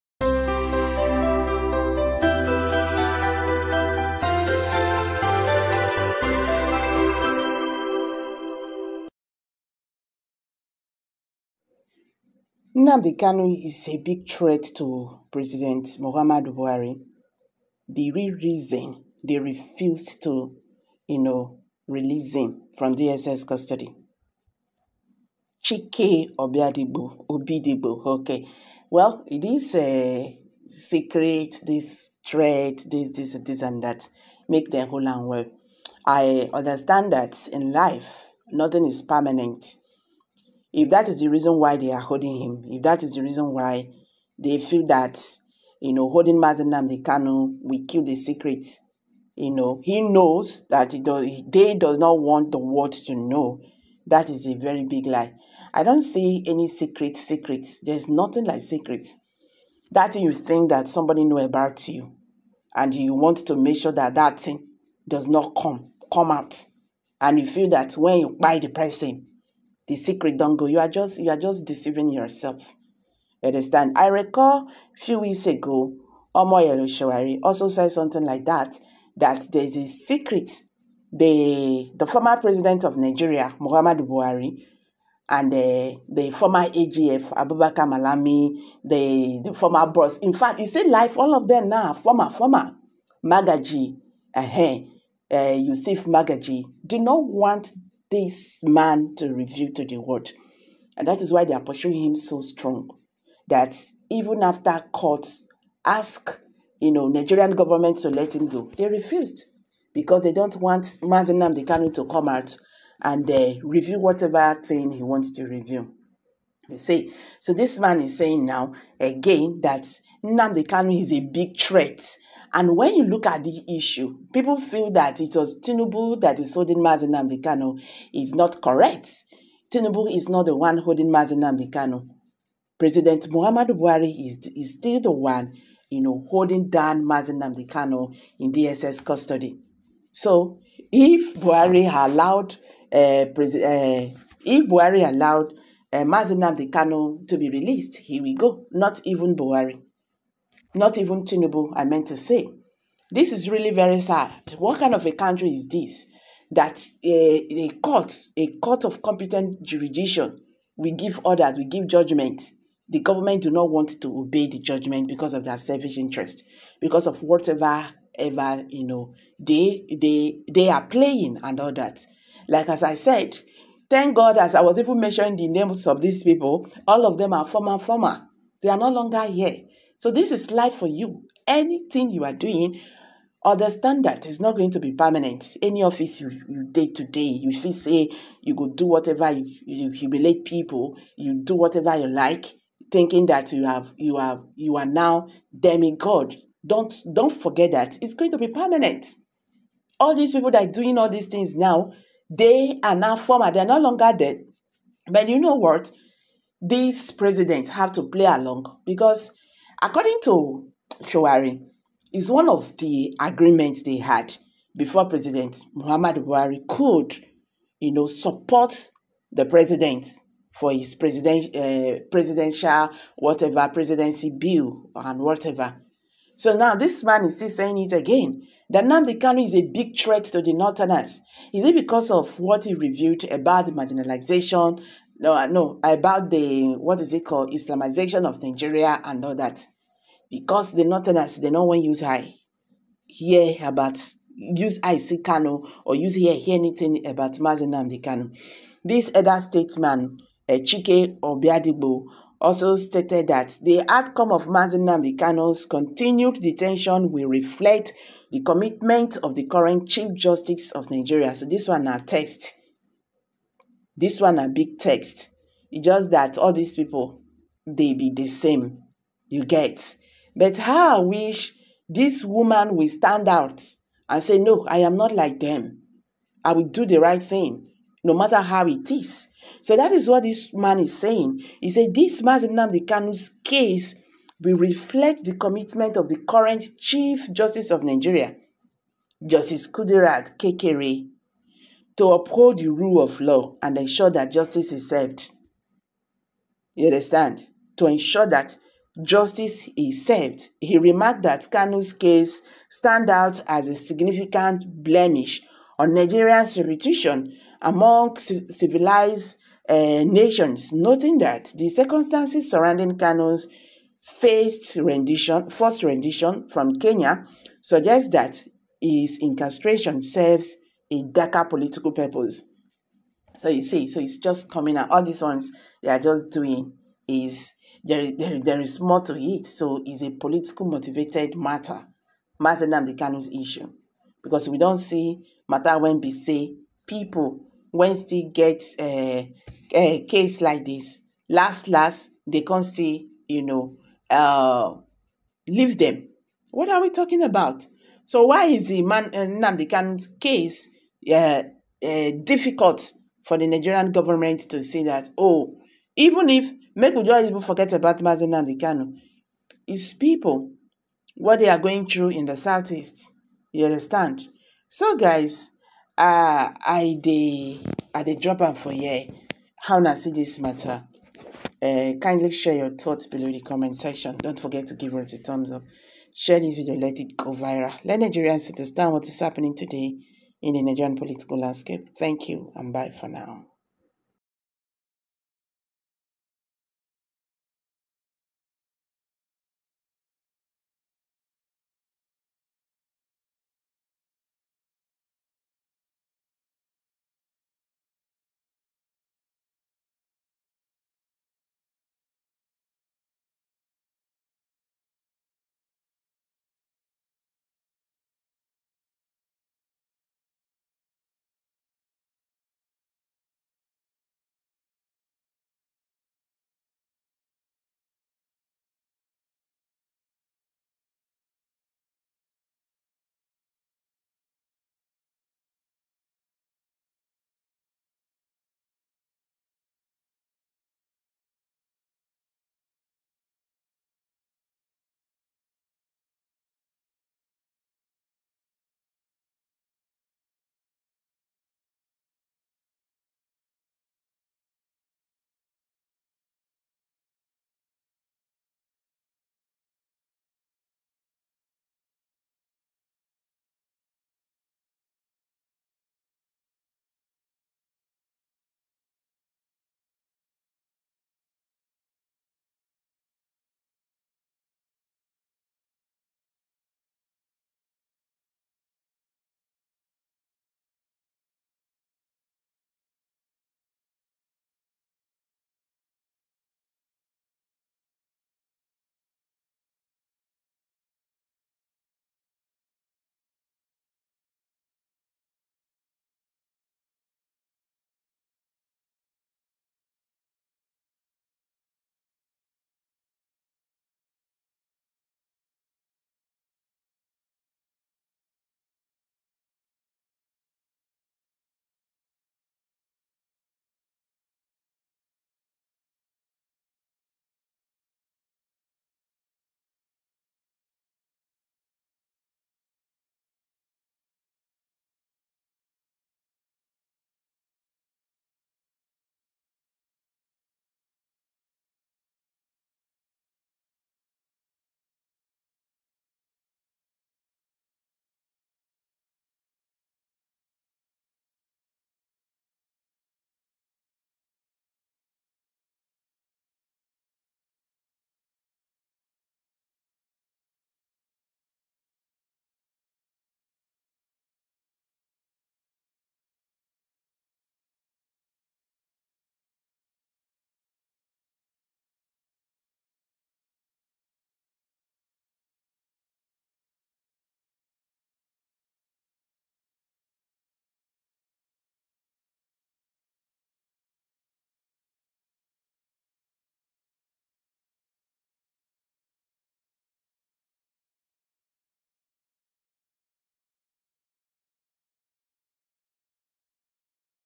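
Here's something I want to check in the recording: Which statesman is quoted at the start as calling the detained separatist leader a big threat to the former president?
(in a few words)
Chike Obiadibo.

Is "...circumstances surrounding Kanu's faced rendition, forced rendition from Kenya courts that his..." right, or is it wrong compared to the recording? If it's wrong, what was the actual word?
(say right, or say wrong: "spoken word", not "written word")
wrong: "suggests", not "courts".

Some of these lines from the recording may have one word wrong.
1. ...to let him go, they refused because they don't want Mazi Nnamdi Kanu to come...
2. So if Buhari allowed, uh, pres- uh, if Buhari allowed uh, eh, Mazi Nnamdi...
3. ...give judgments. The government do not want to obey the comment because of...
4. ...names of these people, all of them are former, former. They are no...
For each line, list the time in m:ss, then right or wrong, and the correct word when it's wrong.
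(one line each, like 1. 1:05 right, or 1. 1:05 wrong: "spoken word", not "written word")
1. 1:47 right
2. 2:20 right
3. 2:41 wrong: "judgment", not "comment"
4. 2:55 right.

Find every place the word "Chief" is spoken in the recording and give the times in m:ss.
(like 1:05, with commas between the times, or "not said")
4:19, 4:46.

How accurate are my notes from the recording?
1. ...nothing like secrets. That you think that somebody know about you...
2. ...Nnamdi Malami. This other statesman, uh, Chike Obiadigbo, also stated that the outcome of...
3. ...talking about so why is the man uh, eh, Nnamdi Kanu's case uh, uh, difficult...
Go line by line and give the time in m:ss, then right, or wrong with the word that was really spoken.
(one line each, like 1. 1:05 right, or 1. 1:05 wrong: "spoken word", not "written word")
1. 0:58 right
2. 4:07 wrong: "Kanu", not "Malami"
3. 5:46 right.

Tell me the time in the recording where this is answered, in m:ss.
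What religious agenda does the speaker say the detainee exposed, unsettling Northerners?
3:57.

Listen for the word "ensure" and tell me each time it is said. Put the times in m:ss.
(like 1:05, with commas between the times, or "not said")
4:53, 4:57.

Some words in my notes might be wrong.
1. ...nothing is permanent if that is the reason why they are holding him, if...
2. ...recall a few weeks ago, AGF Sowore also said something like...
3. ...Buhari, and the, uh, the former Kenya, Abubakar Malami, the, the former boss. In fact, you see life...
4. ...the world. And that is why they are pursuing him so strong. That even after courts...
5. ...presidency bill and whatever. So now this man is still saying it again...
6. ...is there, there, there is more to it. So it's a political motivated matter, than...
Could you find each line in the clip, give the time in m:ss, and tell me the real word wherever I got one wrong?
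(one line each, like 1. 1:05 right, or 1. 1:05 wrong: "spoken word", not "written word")
1. 0:38 right
2. 1:14 wrong: "Omoyele", not "AGF"
3. 1:24 wrong: "AGF", not "Kenya"
4. 1:39 right
5. 3:43 right
6. 5:27 right.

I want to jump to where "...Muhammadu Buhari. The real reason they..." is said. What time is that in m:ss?
0:15.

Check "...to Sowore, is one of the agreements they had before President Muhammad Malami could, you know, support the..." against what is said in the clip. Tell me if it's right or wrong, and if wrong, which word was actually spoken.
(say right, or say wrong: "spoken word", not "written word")
wrong: "Buhari", not "Malami".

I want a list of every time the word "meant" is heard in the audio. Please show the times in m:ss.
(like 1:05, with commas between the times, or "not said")
2:31.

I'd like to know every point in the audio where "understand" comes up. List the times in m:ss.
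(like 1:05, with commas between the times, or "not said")
0:36, 1:13, 3:03, 4:56, 6:03, 6:18.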